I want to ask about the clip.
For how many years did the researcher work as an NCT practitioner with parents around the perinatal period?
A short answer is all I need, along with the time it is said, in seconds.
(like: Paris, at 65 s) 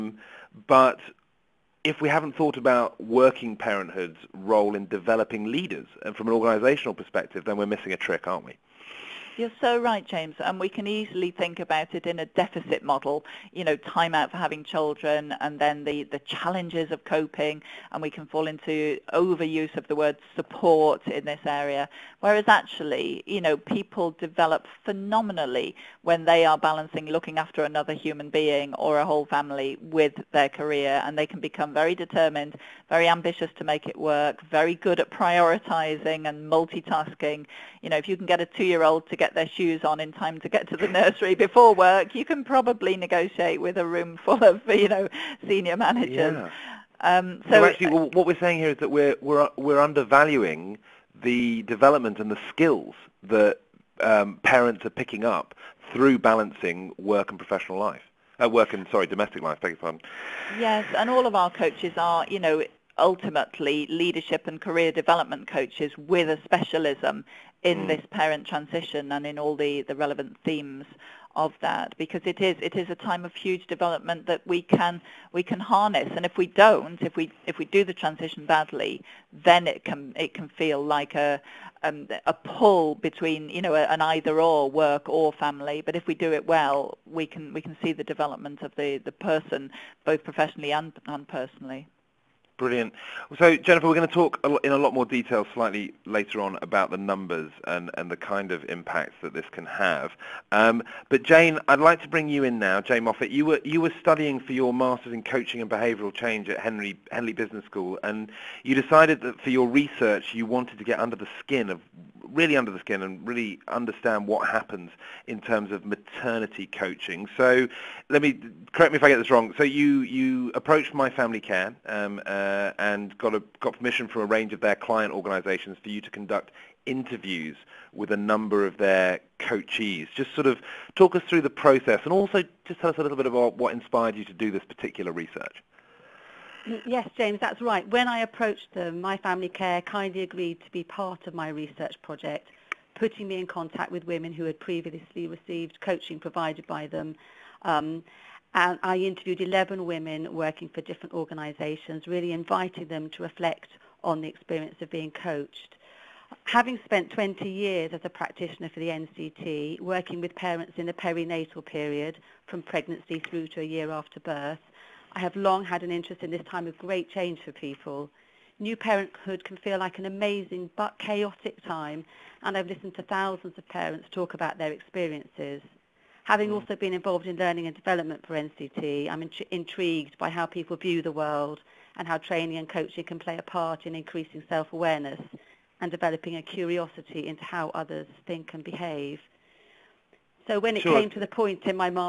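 20, at 157 s.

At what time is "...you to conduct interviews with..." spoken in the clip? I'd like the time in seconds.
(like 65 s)
125 s.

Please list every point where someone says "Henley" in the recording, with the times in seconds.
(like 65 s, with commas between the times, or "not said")
107 s.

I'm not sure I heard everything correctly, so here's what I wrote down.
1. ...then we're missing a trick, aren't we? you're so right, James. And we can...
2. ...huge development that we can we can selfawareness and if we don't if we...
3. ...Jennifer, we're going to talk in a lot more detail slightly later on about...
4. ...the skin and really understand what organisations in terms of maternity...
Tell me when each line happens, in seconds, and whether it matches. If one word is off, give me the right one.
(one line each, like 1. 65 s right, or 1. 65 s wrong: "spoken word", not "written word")
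1. 7 s right
2. 73 s wrong: "harness", not "selfawareness"
3. 93 s right
4. 112 s wrong: "happens", not "organisations".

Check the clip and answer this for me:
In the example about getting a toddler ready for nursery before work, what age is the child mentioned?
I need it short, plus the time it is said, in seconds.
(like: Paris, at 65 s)
2, at 38 s.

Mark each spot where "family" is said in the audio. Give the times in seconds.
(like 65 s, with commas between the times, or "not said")
29 s, 85 s, 121 s, 139 s.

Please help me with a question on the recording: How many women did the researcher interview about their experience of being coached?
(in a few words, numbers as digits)
11.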